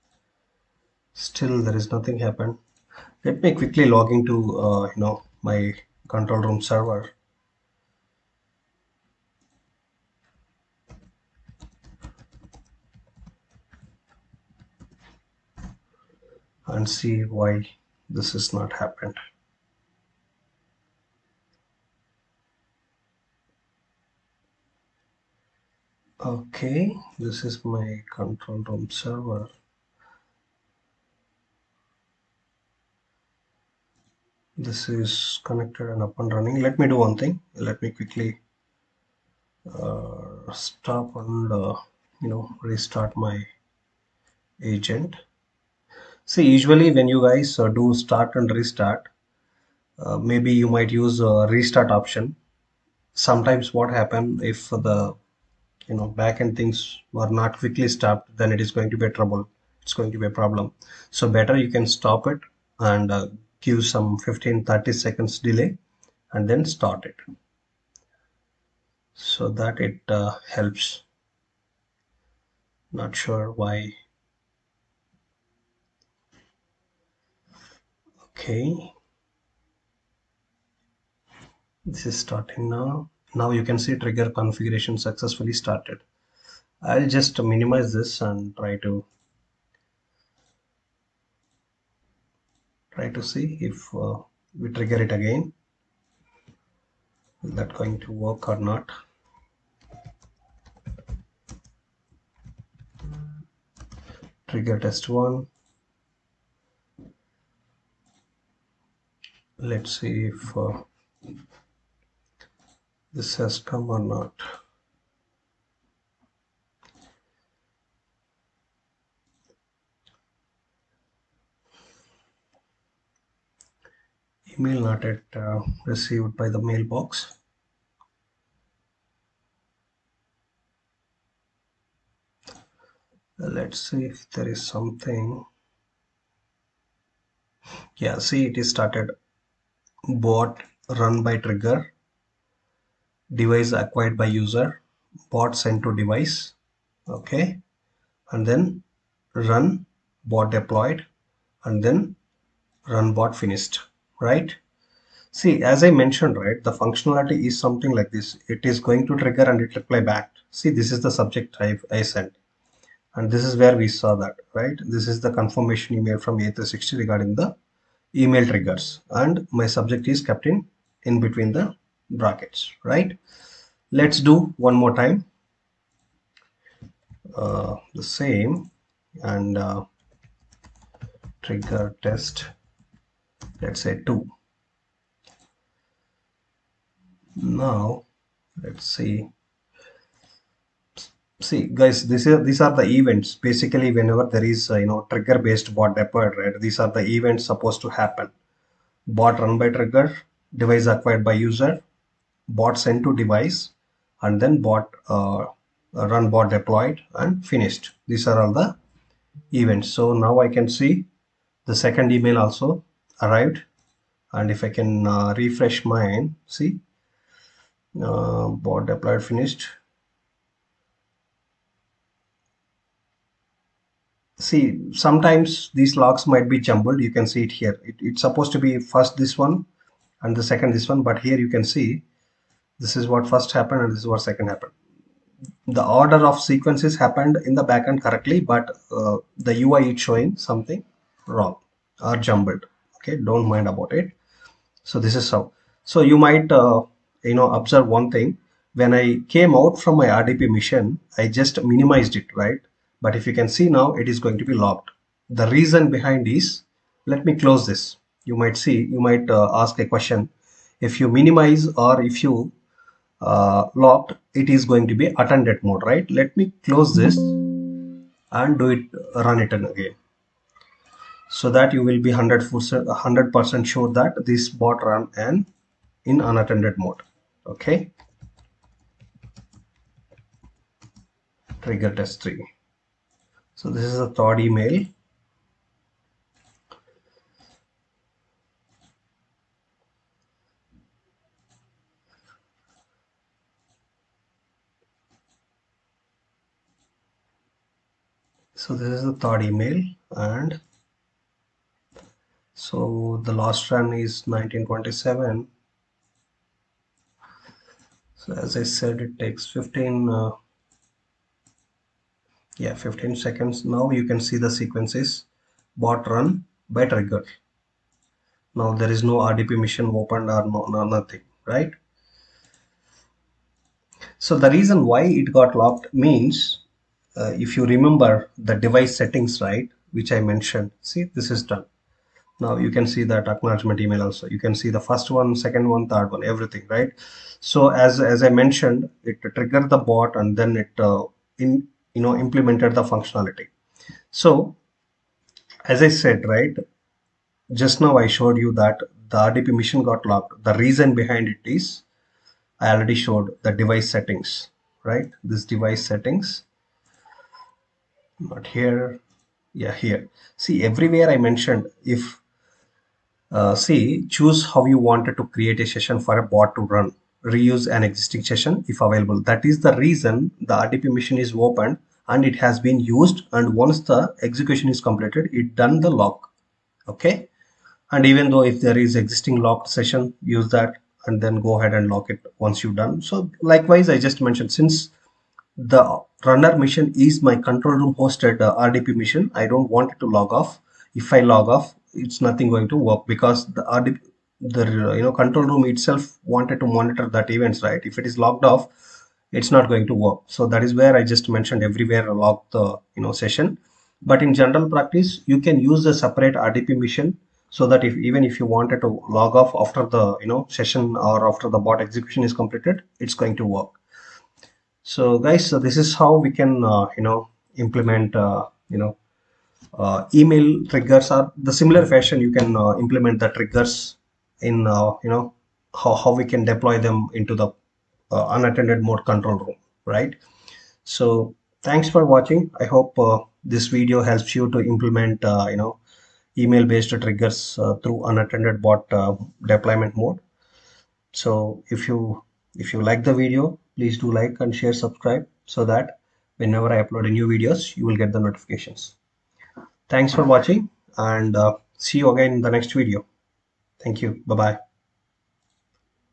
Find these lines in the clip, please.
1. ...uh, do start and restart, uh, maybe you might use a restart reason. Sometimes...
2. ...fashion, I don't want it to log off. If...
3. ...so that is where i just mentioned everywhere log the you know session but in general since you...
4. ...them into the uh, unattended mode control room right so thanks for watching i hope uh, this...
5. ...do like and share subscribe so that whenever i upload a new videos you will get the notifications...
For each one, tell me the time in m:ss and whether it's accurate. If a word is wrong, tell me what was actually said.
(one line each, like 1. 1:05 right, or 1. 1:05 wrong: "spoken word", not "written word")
1. 0:47 wrong: "option", not "reason"
2. 6:28 wrong: "mission", not "fashion"
3. 6:40 wrong: "practice", not "since"
4. 7:06 right
5. 7:23 right.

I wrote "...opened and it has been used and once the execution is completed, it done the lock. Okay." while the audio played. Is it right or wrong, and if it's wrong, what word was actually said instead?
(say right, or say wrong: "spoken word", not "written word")
right.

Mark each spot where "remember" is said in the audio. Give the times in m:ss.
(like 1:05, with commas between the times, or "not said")
5:27.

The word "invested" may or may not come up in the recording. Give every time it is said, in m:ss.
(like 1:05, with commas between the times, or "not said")
not said.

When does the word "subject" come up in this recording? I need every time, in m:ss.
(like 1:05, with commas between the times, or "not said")
2:41, 2:49.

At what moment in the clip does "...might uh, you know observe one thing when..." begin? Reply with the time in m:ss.
4:06.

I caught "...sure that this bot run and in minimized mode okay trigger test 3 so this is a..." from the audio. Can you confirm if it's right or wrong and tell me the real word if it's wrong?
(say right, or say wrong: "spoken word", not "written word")
wrong: "unattended", not "minimized".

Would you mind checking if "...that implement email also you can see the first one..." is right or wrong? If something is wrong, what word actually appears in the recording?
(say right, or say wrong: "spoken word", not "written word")
wrong: "acknowledgement", not "implement".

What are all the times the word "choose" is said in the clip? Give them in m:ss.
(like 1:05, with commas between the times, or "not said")
6:04.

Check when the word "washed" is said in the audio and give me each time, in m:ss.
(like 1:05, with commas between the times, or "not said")
not said.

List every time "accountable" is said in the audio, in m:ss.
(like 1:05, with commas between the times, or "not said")
not said.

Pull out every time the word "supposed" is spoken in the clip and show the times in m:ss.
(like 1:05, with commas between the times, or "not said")
3:17, 3:48.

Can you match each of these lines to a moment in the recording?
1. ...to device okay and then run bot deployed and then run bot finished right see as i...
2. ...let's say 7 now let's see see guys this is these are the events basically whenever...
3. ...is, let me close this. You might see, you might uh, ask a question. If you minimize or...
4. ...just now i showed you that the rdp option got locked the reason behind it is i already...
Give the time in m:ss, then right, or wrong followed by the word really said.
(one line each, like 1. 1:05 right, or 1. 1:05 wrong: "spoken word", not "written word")
1. 2:25 right
2. 3:03 wrong: "2", not "7"
3. 4:16 right
4. 5:47 wrong: "mission", not "option".